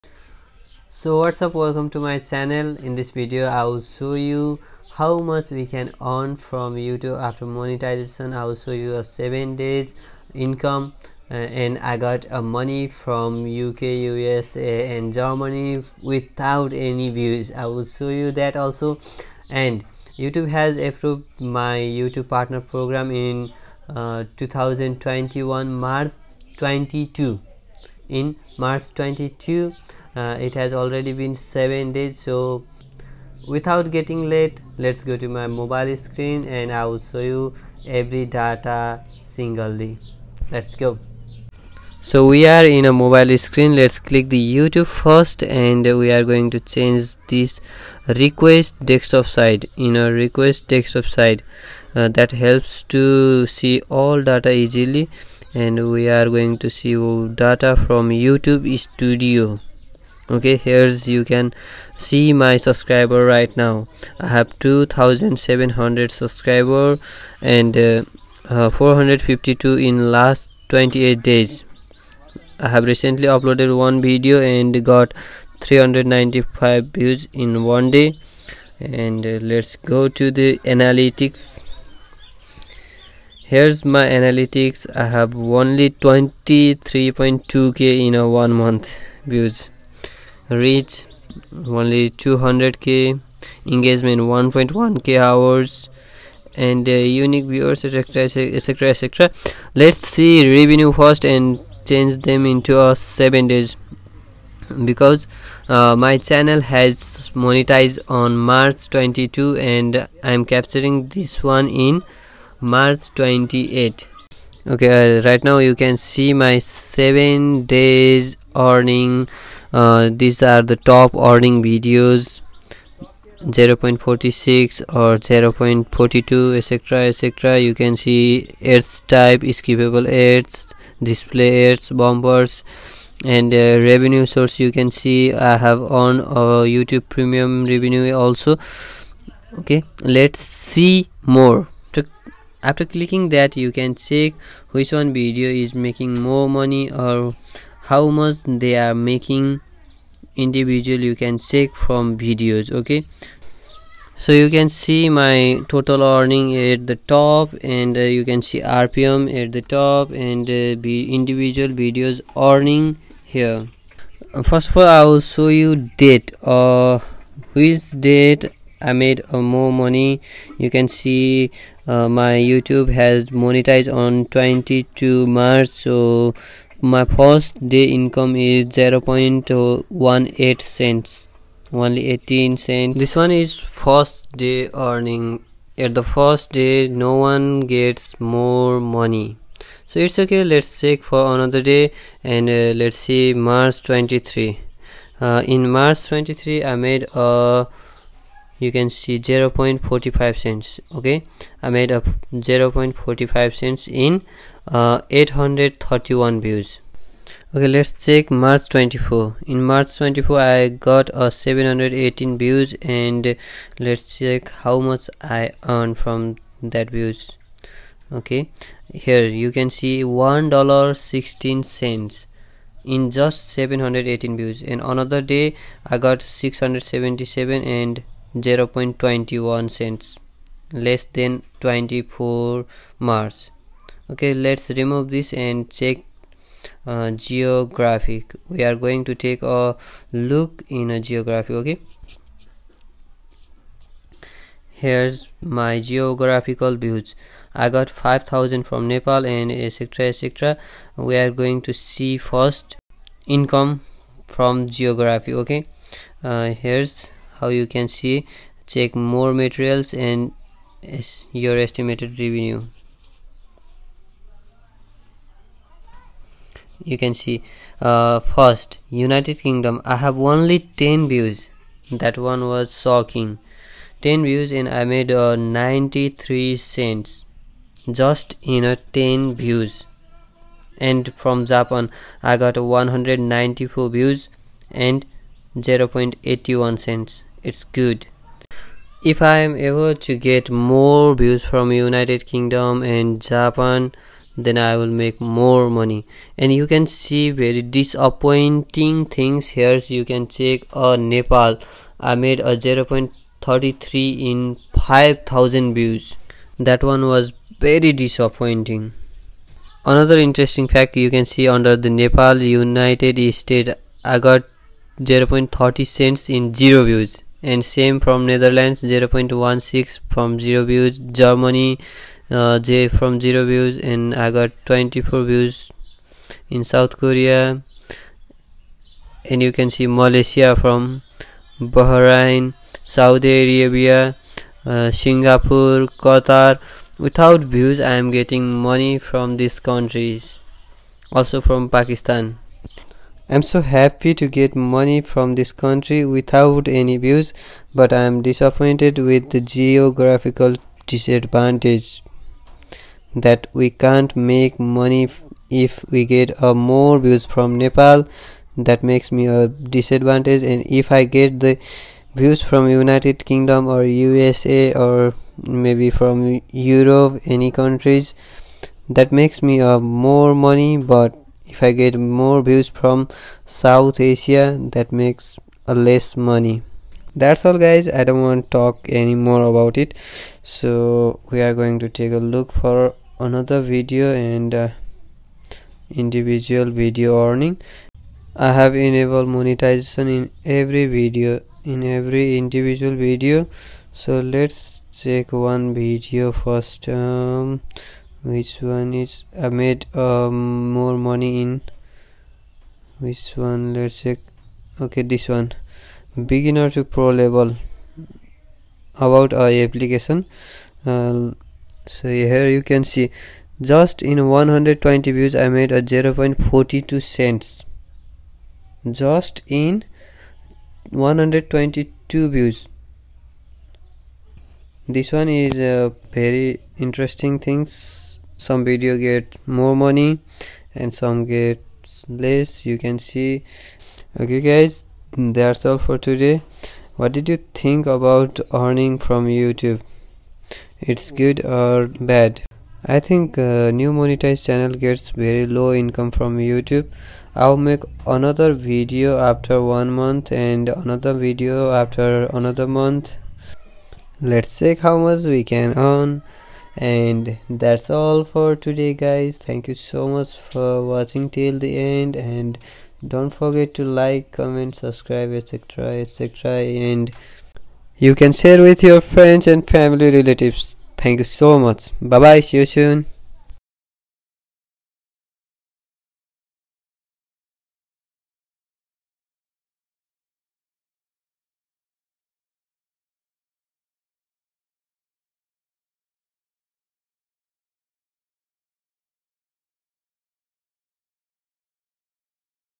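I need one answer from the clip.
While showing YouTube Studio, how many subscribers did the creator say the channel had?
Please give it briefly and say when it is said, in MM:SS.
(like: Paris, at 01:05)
2700, at 01:04.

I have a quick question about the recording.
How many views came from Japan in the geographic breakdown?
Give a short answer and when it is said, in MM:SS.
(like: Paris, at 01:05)
194, at 04:42.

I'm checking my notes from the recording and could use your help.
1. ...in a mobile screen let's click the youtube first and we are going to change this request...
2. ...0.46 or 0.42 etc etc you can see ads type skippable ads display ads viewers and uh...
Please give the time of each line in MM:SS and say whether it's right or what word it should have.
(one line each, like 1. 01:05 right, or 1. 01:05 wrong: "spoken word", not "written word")
1. 00:42 right
2. 02:03 wrong: "bumpers", not "viewers".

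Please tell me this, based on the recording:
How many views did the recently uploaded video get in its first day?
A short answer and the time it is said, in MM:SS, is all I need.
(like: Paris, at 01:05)
395, at 01:15.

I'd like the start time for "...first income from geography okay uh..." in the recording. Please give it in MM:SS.
04:12.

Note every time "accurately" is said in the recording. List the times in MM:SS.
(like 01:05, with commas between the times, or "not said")
not said.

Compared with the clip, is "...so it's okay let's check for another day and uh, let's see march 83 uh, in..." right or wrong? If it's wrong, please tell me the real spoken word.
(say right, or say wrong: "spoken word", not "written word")
wrong: "23", not "83".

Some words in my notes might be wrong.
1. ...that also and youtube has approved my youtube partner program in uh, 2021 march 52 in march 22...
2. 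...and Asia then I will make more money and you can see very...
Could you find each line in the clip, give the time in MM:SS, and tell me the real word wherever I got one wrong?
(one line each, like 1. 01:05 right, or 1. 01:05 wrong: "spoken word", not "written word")
1. 00:18 wrong: "22", not "52"
2. 04:52 wrong: "Japan", not "Asia".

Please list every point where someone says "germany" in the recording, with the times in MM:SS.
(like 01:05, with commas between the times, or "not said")
00:15, 05:20.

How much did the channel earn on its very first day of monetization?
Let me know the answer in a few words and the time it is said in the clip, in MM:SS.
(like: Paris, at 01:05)
18 cents, at 03:01.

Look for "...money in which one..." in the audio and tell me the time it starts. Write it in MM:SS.
06:40.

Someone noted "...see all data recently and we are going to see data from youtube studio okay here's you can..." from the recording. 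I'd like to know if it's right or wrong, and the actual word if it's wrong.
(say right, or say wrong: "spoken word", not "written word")
wrong: "easily", not "recently".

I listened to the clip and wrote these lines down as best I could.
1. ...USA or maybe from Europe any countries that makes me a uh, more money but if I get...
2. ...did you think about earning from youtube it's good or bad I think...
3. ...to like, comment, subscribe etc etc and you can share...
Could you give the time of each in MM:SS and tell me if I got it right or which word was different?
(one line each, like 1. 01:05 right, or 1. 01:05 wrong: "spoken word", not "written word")
1. 06:03 right
2. 07:17 right
3. 07:43 right.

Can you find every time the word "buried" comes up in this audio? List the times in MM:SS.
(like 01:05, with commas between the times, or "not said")
not said.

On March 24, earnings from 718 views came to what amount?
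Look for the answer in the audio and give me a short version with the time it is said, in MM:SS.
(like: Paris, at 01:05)
$1.16, at 03:40.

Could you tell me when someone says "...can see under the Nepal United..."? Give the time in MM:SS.
05:11.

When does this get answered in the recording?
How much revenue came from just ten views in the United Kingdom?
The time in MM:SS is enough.
04:35.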